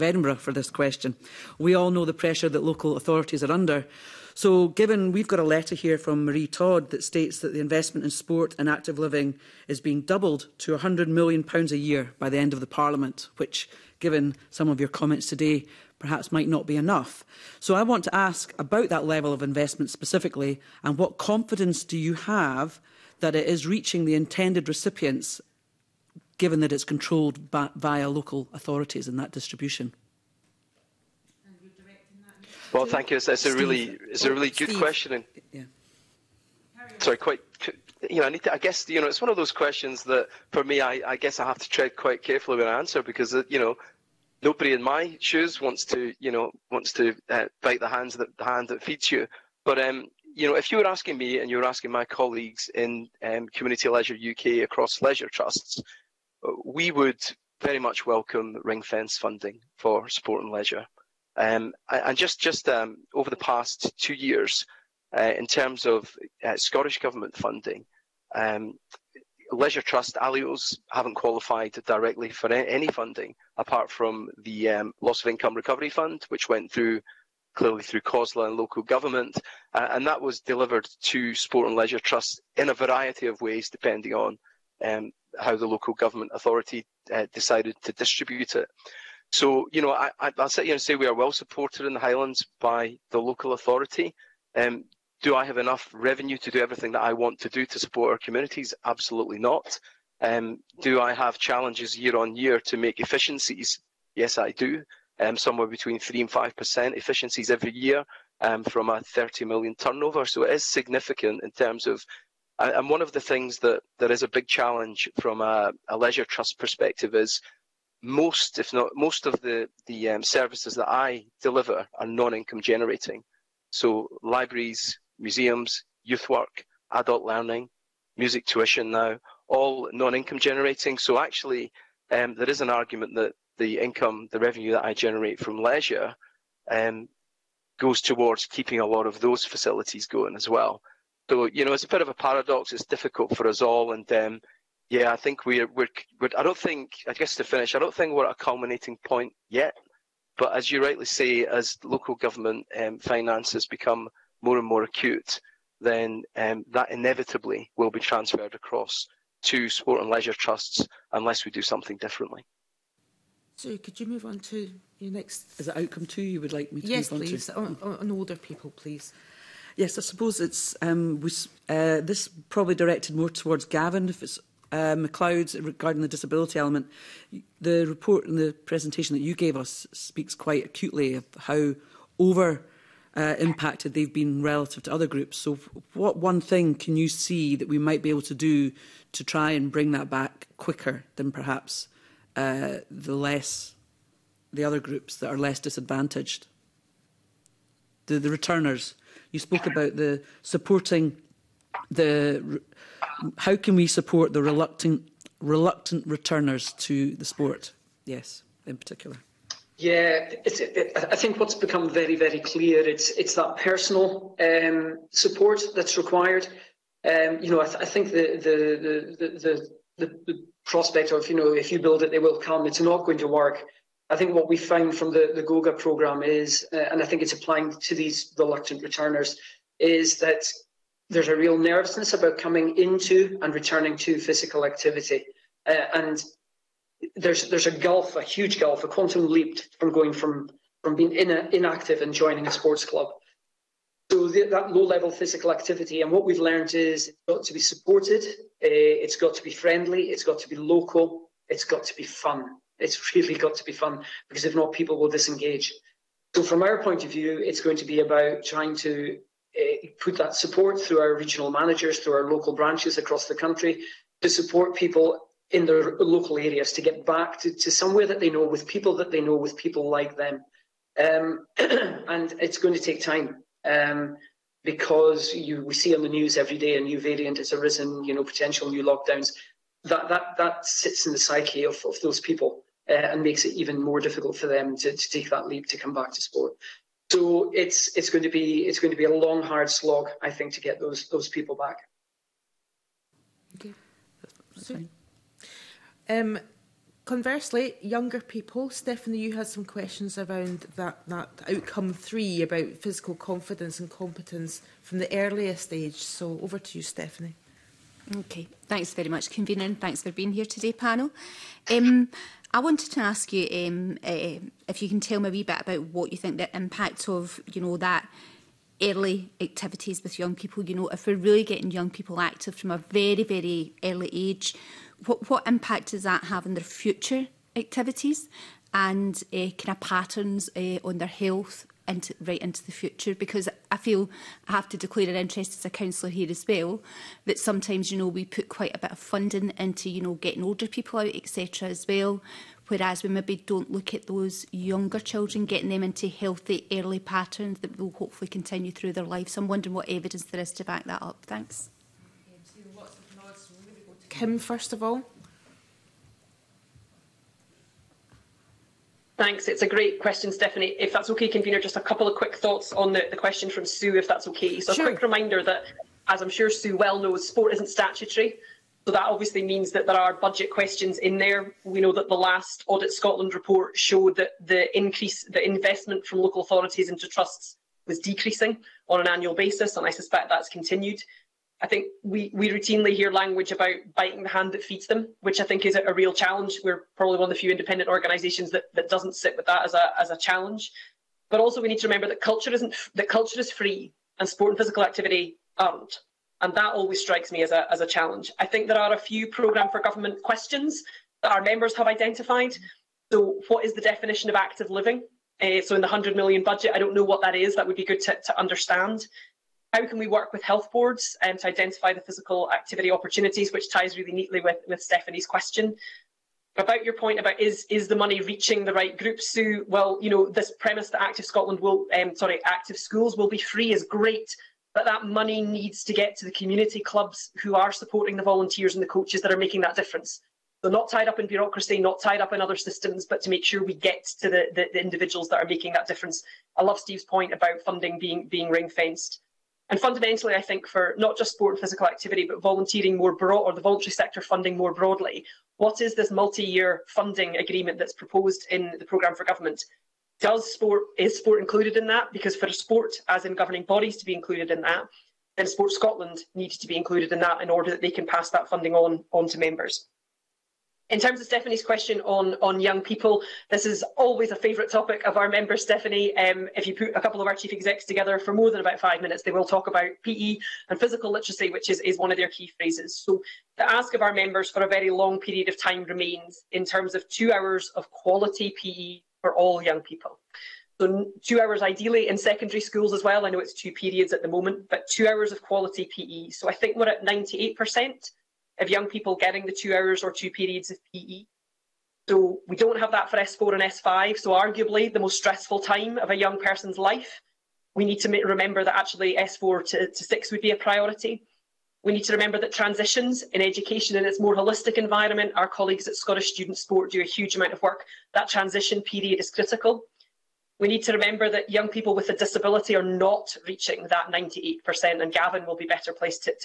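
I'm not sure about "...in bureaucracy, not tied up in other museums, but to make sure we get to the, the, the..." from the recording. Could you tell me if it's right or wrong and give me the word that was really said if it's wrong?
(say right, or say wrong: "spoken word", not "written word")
wrong: "systems", not "museums".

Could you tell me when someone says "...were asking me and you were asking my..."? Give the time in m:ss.
0:50.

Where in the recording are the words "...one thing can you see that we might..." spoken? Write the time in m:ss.
3:06.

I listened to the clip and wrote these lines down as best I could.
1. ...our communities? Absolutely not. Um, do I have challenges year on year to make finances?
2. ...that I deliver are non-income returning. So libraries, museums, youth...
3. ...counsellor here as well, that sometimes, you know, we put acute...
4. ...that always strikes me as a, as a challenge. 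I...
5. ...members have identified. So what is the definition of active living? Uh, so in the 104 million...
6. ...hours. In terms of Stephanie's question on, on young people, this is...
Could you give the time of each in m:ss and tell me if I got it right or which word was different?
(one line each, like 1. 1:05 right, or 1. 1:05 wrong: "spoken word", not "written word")
1. 1:38 wrong: "efficiencies", not "finances"
2. 2:00 wrong: "generating", not "returning"
3. 5:35 wrong: "quite", not "acute"
4. 6:36 right
5. 6:41 wrong: "100", not "104"
6. 7:39 wrong: "members", not "hours".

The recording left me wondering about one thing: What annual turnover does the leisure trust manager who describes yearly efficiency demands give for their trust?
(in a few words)
30 million.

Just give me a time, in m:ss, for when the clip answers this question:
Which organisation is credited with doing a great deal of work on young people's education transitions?
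8:25.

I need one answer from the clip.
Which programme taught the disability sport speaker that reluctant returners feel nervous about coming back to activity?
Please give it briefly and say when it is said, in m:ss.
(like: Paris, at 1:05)
Goga, at 3:45.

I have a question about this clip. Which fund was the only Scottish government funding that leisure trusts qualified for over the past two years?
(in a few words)
Loss of Income Recovery Fund.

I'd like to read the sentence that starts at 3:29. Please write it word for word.
Yeah, it, I think what's become very, very clear it's it's that personal um, support that's required.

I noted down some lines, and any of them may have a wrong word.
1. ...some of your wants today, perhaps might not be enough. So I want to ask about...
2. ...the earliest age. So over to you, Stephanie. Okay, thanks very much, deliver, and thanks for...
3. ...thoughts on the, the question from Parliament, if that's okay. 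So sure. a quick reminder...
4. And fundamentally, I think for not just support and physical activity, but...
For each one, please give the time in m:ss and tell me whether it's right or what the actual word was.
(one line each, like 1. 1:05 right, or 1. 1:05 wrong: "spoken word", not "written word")
1. 0:14 wrong: "comments", not "wants"
2. 5:04 wrong: "convener", not "deliver"
3. 6:02 wrong: "Sue", not "Parliament"
4. 7:19 wrong: "sport", not "support".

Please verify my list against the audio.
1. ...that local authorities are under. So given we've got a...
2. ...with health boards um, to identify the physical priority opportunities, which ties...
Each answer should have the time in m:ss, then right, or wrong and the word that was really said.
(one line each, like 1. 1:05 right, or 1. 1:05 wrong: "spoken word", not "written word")
1. 0:02 right
2. 6:50 wrong: "activity", not "priority".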